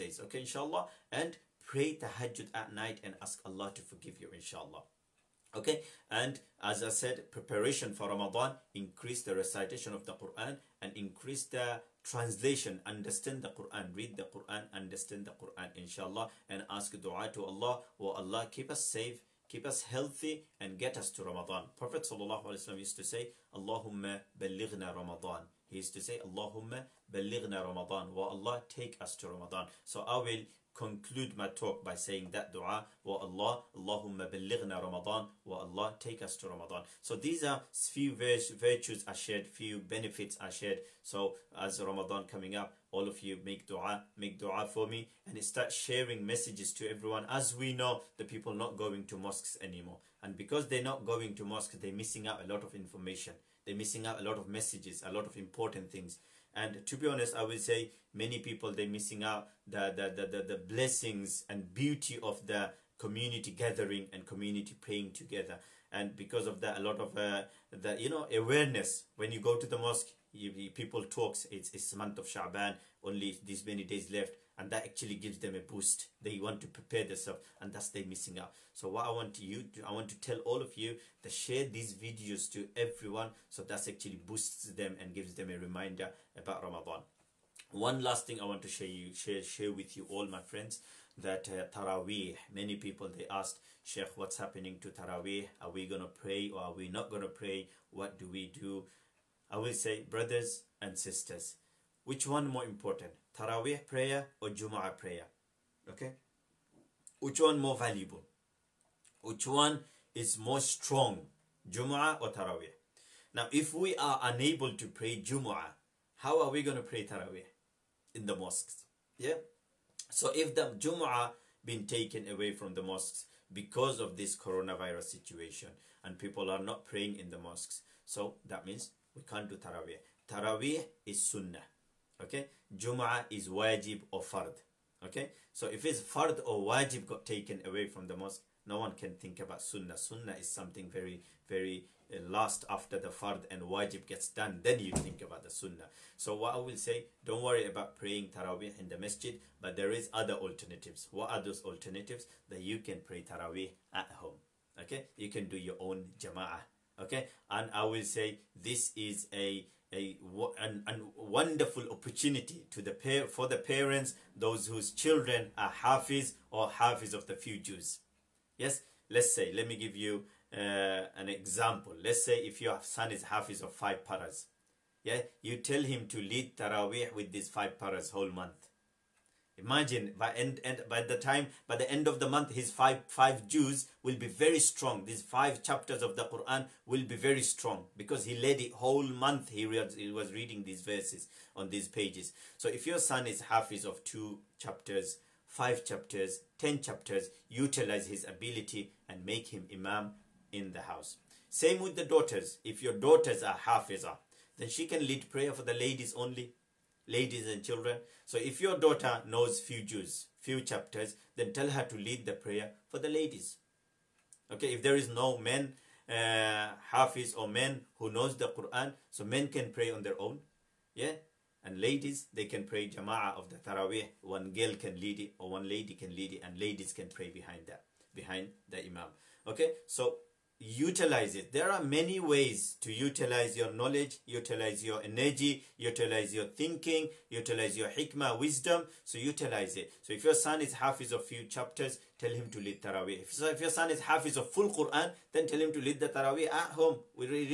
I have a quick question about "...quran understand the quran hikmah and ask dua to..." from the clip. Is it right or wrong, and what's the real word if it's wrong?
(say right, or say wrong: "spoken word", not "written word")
wrong: "inshallah", not "hikmah".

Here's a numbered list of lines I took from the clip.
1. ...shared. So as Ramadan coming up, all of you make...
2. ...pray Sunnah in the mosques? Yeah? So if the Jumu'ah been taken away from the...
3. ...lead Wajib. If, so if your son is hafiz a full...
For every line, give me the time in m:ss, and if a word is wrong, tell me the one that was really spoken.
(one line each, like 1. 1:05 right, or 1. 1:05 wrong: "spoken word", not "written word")
1. 0:40 right
2. 1:56 wrong: "Taraweeh", not "Sunnah"
3. 4:02 wrong: "Taraweeh", not "Wajib".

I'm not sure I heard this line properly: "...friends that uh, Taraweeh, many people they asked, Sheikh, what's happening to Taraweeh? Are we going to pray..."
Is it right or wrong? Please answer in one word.
right.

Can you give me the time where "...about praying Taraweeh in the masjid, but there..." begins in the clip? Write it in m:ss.
2:27.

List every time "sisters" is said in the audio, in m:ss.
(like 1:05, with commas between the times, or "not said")
1:40.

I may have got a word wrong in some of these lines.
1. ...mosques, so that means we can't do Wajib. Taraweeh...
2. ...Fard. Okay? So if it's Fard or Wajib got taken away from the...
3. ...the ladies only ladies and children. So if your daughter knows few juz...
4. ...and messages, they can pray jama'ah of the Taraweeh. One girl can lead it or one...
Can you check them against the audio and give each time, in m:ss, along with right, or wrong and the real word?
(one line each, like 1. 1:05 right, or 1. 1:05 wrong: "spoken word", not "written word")
1. 2:07 wrong: "Taraweeh", not "Wajib"
2. 2:14 right
3. 3:25 right
4. 3:41 wrong: "ladies", not "messages".